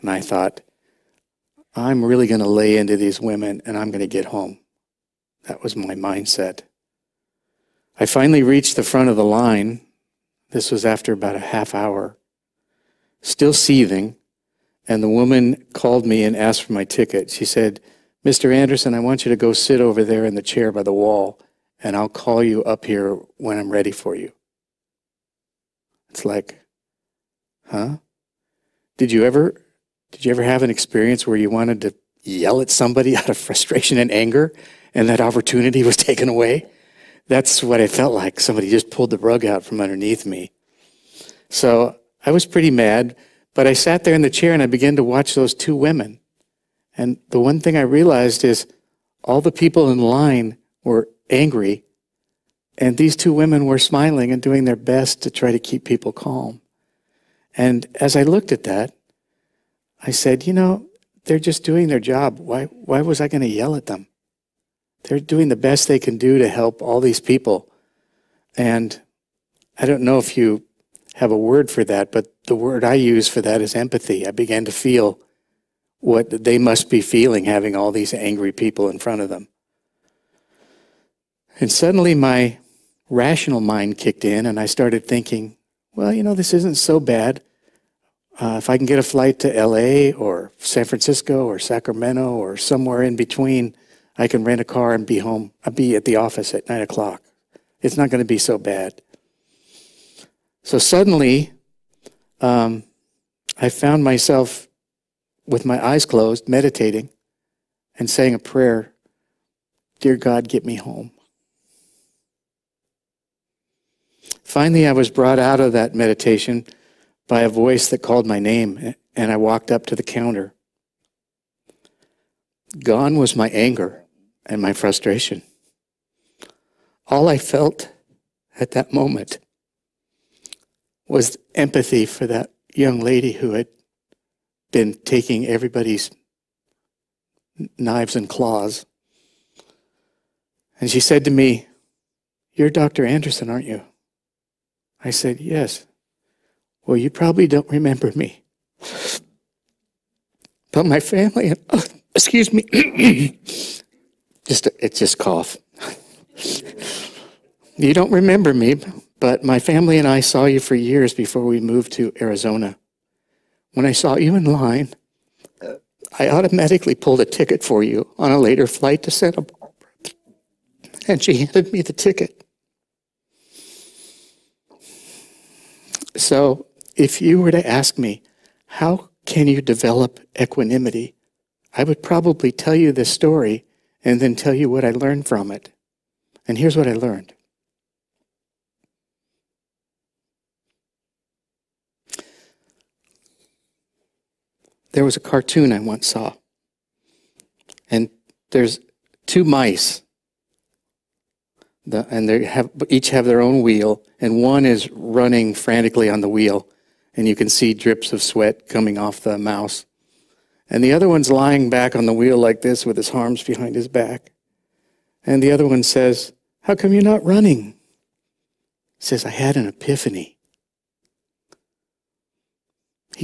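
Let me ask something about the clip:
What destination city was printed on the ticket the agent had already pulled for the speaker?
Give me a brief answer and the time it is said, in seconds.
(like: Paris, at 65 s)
Santa Barbara, at 169 s.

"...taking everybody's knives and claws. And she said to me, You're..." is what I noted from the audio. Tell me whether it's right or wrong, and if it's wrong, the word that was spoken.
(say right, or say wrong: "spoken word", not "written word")
right.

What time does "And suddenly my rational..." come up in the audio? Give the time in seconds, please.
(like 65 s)
81 s.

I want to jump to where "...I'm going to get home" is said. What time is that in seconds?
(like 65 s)
3 s.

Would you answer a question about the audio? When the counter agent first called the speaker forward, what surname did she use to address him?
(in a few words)
Mr. Anderson.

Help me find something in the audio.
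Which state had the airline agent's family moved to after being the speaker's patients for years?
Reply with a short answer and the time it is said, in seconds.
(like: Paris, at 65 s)
Arizona, at 162 s.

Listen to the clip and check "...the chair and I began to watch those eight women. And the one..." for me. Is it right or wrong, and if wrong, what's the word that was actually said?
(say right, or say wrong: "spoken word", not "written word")
wrong: "two", not "eight".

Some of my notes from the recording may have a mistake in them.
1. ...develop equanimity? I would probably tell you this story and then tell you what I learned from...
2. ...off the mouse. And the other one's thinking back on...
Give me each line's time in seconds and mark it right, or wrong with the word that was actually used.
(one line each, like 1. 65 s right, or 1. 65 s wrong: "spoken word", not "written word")
1. 179 s right
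2. 208 s wrong: "lying", not "thinking".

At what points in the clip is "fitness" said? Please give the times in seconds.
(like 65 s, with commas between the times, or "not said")
not said.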